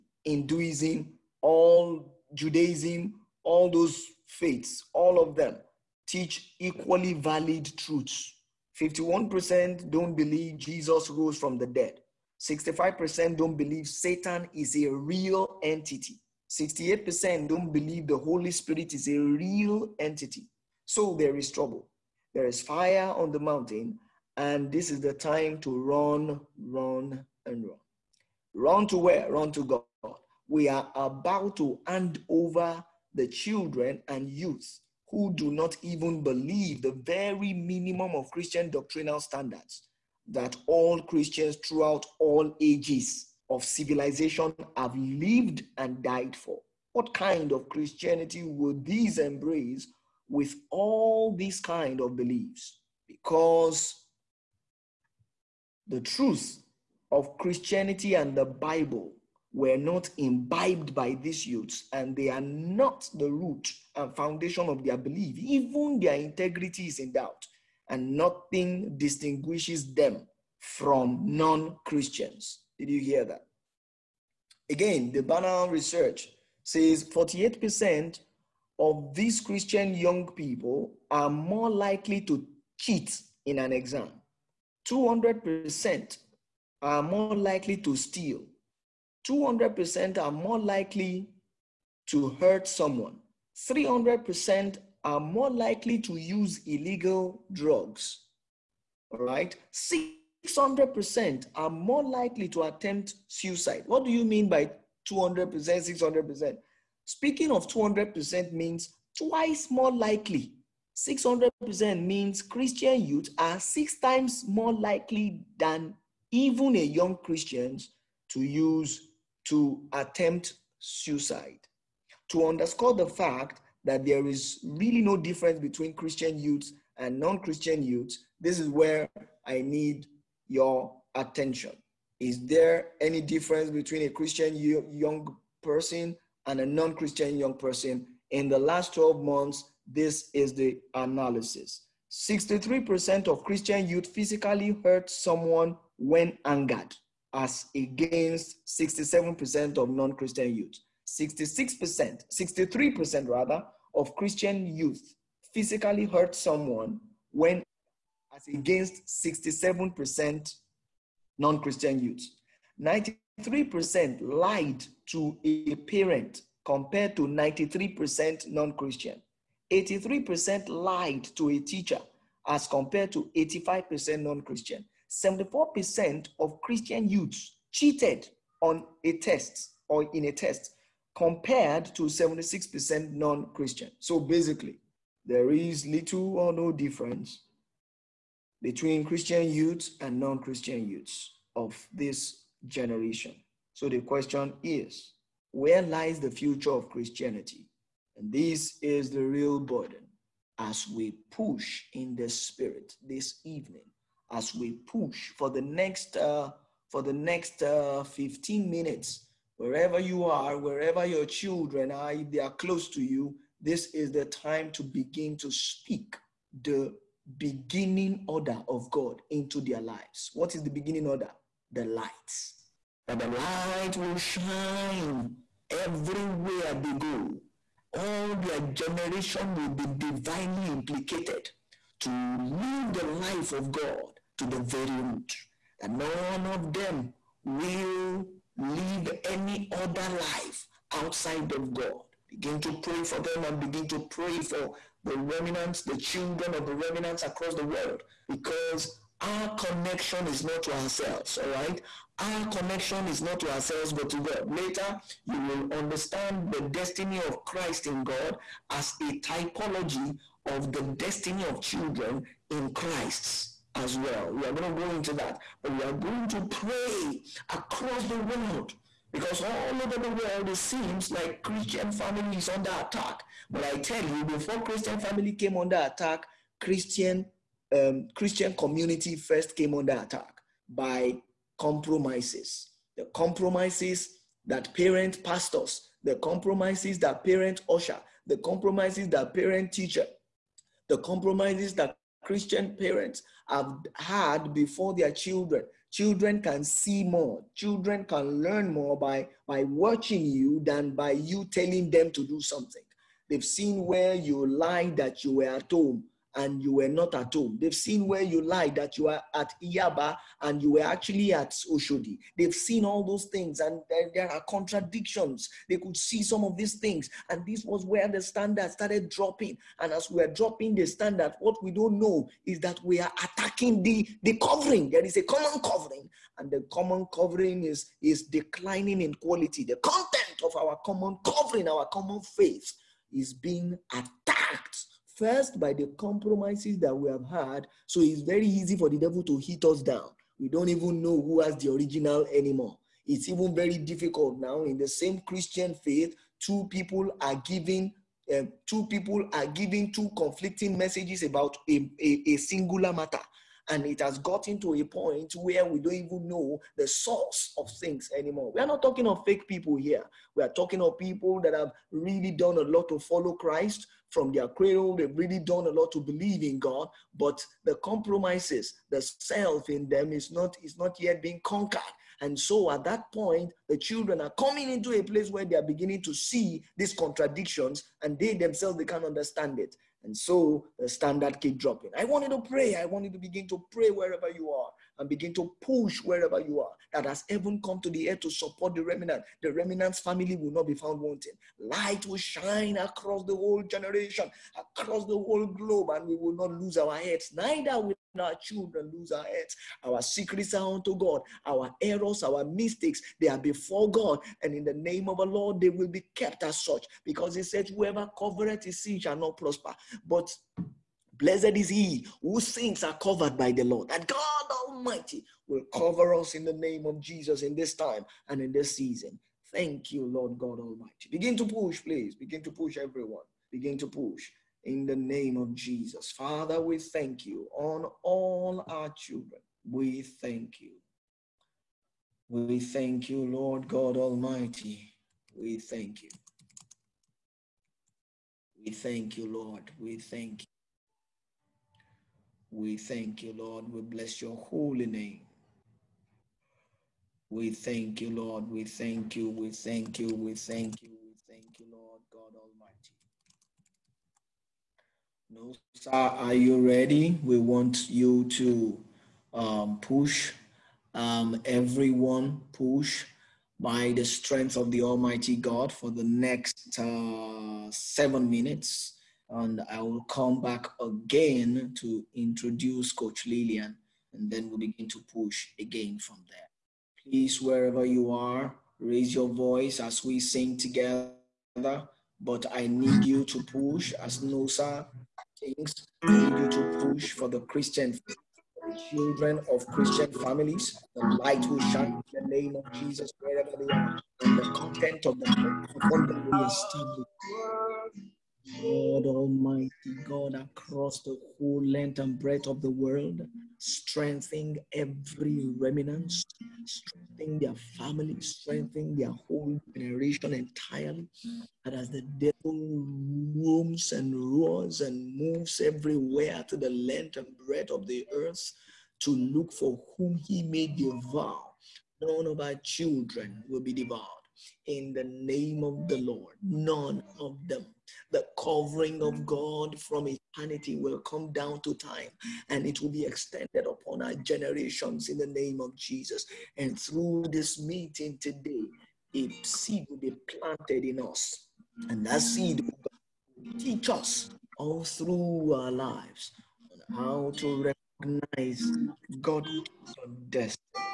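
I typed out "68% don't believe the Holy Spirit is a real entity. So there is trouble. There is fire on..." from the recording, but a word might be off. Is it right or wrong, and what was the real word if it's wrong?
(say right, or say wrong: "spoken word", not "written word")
right.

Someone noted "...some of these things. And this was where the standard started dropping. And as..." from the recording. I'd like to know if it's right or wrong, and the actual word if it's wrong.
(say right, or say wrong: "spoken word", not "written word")
right.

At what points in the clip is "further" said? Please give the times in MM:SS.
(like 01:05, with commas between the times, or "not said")
not said.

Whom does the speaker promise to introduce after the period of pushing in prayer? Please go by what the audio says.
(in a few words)
Coach Lillian.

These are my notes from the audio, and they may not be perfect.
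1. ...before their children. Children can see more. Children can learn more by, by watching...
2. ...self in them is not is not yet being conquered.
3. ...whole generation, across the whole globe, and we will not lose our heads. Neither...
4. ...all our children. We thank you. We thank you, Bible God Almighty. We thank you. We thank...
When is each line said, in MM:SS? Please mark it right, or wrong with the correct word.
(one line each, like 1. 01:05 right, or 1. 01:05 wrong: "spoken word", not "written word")
1. 04:54 right
2. 06:09 right
3. 06:33 right
4. 07:08 wrong: "Lord", not "Bible".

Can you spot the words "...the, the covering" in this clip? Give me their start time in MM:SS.
05:23.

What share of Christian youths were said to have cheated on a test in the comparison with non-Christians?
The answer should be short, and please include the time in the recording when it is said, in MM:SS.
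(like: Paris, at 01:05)
74%, at 02:55.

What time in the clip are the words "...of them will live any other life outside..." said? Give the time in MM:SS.
03:56.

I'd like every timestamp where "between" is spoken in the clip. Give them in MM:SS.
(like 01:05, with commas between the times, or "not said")
02:05, 02:13, 03:08.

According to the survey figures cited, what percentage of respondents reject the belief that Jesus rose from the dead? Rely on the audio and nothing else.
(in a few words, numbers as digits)
51%.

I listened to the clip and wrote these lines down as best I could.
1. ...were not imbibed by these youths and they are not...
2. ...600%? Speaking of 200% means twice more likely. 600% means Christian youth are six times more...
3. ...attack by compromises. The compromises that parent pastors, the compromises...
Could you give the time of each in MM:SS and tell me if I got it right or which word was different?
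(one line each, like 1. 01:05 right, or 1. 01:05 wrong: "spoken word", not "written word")
1. 00:59 right
2. 01:45 right
3. 04:39 right.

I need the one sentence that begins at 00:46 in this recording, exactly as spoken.
What kind of Christianity would these embrace with all these kind of beliefs?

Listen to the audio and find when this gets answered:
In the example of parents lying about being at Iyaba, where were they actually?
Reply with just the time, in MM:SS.
05:11.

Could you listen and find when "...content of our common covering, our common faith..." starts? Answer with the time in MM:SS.
05:29.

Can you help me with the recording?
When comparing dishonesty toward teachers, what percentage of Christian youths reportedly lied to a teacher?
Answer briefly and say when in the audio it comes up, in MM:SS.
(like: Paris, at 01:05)
83%, at 02:49.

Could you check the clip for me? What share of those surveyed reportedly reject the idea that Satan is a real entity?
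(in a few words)
65%.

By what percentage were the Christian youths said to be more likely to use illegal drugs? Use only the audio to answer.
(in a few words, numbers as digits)
300%.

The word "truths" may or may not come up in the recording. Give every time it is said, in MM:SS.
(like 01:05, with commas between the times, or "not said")
00:07, 00:56.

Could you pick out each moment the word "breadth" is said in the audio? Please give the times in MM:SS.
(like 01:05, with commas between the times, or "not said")
08:22, 08:37.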